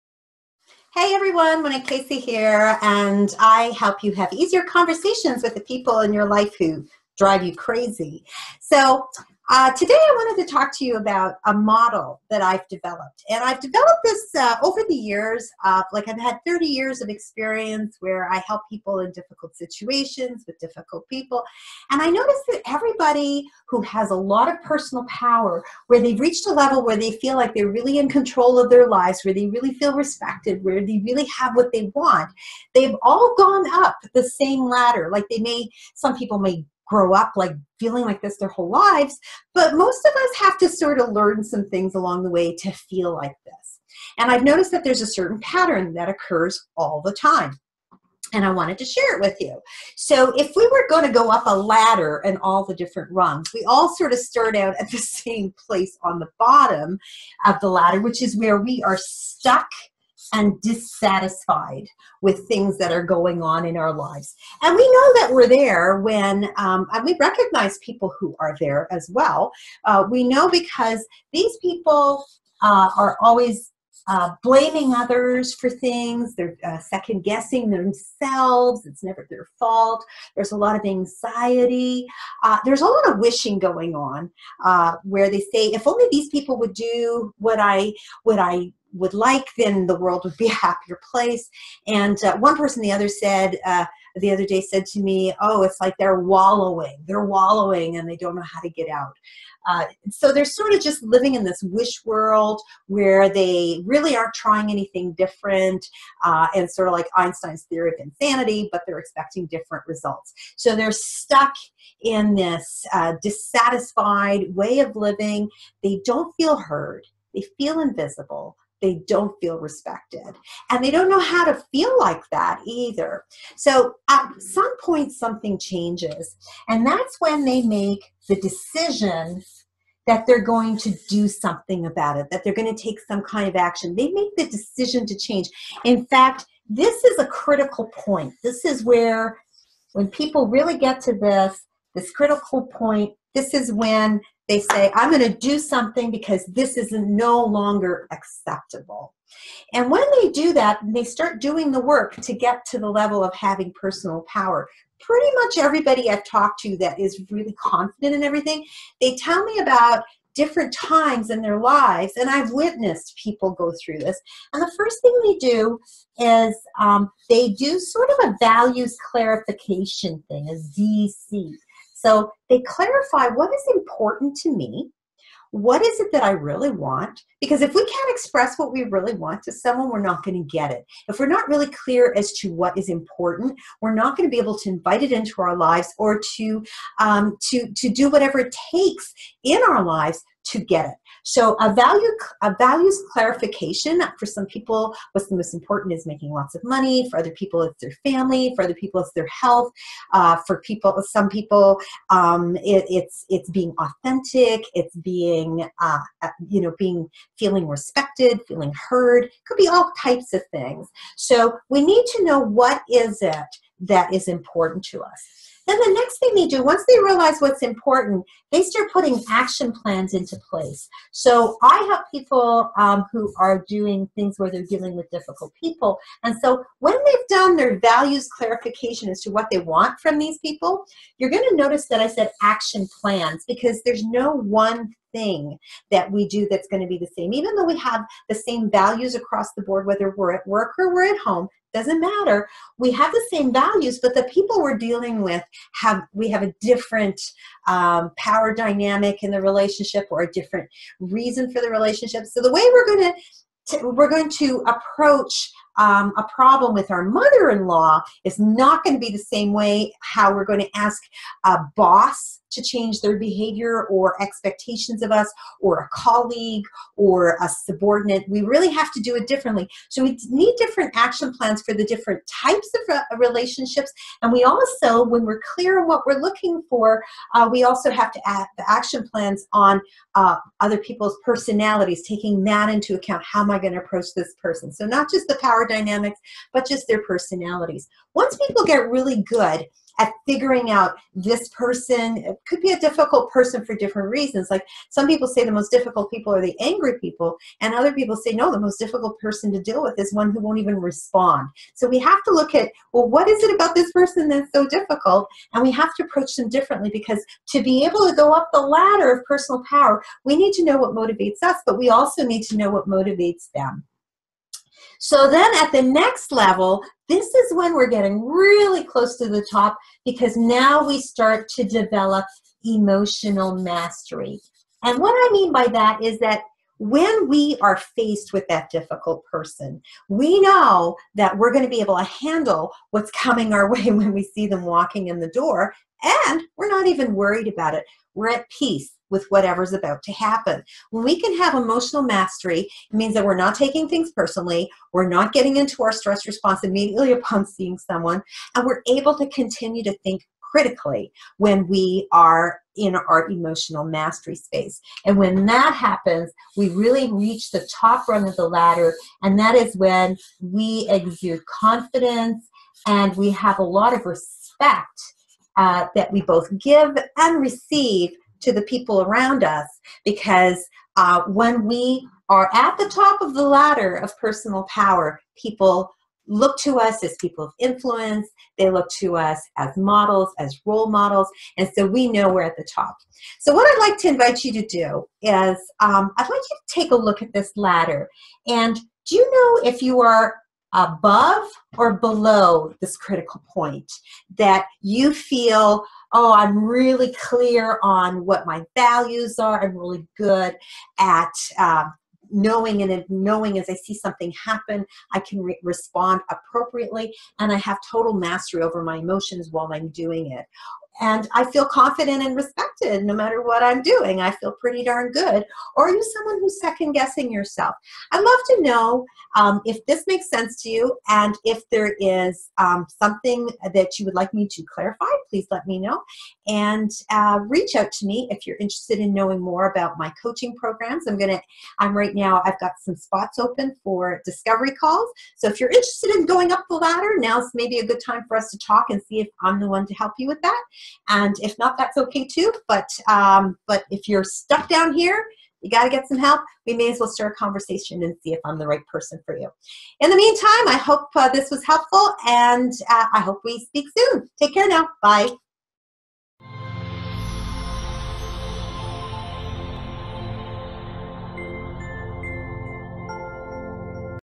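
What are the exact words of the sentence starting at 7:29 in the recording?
In the meantime, I hope uh, this was helpful and uh, I hope we speak soon.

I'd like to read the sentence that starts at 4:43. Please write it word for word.
How am I going to approach this person?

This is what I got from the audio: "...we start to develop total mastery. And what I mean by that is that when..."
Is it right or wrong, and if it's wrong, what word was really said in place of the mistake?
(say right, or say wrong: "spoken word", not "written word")
wrong: "emotional", not "total".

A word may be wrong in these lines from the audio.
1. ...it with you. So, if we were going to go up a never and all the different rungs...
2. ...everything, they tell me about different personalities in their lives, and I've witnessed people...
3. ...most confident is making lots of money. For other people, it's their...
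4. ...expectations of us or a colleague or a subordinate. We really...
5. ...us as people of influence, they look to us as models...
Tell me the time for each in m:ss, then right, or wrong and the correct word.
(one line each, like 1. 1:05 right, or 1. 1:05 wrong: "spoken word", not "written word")
1. 0:49 wrong: "ladder", not "never"
2. 2:38 wrong: "times", not "personalities"
3. 3:15 wrong: "important", not "confident"
4. 4:24 right
5. 6:16 right.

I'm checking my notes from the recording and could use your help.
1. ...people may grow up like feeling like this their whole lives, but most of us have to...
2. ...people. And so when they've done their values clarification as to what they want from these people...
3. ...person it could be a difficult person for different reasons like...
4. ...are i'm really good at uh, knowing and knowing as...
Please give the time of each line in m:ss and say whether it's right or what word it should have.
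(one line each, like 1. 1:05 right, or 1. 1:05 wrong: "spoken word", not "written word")
1. 0:36 right
2. 3:45 right
3. 4:51 right
4. 6:39 right.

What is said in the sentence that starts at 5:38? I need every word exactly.
We're at peace with whatever's about to happen.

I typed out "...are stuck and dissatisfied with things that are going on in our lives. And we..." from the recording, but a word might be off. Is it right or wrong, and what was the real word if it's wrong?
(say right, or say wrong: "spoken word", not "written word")
right.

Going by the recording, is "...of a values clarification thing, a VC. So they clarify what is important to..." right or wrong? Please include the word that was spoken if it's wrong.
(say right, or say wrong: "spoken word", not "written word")
right.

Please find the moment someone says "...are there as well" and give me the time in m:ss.
1:08.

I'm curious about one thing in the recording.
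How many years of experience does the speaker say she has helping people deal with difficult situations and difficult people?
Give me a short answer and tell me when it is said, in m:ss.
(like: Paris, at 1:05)
30, at 0:16.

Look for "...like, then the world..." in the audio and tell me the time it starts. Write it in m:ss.
1:29.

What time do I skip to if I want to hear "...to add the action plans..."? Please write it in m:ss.
4:38.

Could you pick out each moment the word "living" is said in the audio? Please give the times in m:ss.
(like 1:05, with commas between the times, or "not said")
1:41, 1:54.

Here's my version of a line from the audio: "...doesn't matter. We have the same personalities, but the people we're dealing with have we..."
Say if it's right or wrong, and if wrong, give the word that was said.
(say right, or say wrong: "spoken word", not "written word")
wrong: "values", not "personalities".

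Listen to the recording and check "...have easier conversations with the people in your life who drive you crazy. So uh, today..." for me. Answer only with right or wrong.
right.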